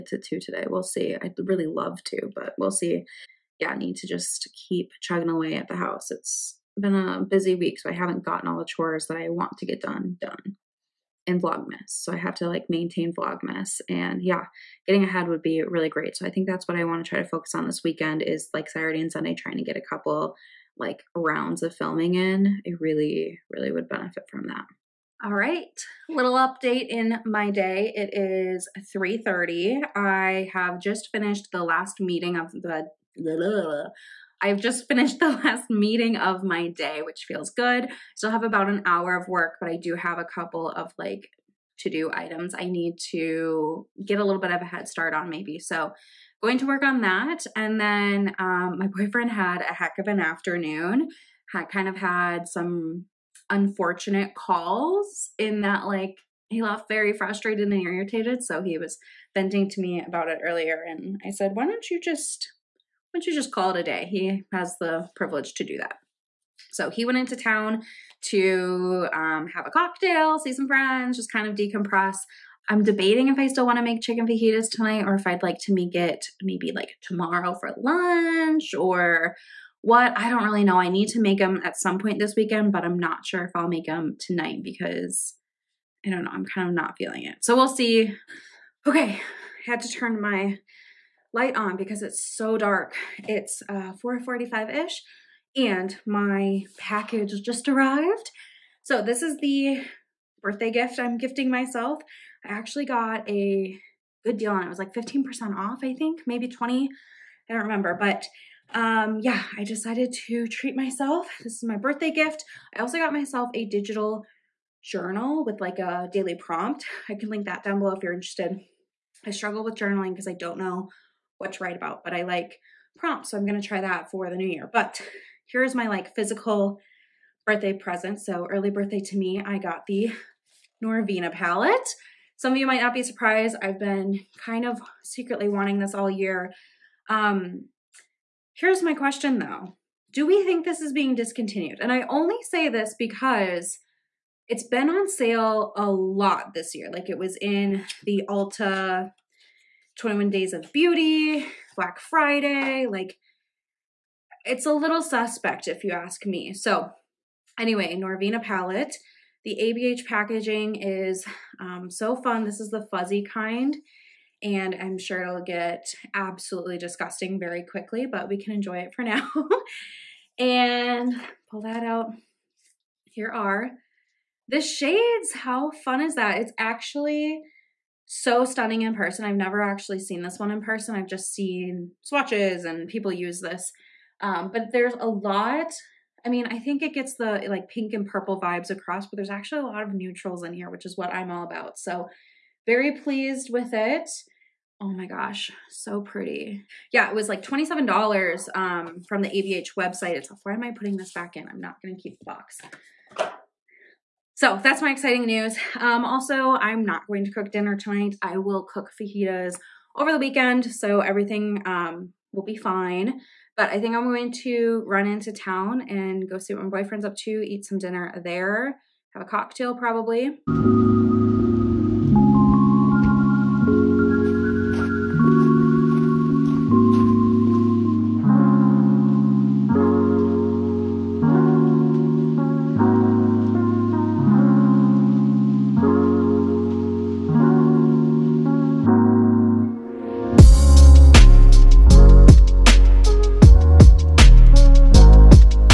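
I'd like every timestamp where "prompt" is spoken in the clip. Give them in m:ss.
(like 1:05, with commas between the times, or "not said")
1:56, 2:02.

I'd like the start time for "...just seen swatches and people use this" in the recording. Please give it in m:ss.
3:01.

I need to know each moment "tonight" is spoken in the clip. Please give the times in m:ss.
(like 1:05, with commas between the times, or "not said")
1:14, 1:24, 3:27.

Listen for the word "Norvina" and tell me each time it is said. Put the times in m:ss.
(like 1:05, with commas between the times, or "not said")
2:10, 2:37.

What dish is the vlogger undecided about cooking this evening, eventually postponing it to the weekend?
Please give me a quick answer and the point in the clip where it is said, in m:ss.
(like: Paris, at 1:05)
chicken fajitas, at 1:14.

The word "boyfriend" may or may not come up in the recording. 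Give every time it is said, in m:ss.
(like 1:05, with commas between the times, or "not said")
0:48, 3:36.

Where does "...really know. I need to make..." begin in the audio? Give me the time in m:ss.
1:20.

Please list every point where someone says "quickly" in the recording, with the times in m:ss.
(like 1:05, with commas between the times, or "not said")
2:47.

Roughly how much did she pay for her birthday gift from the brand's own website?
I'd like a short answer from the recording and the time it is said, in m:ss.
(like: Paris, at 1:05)
$27, at 3:17.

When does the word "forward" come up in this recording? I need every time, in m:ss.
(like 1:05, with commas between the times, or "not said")
not said.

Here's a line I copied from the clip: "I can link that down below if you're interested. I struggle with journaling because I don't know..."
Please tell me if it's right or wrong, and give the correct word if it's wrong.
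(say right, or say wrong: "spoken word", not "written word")
right.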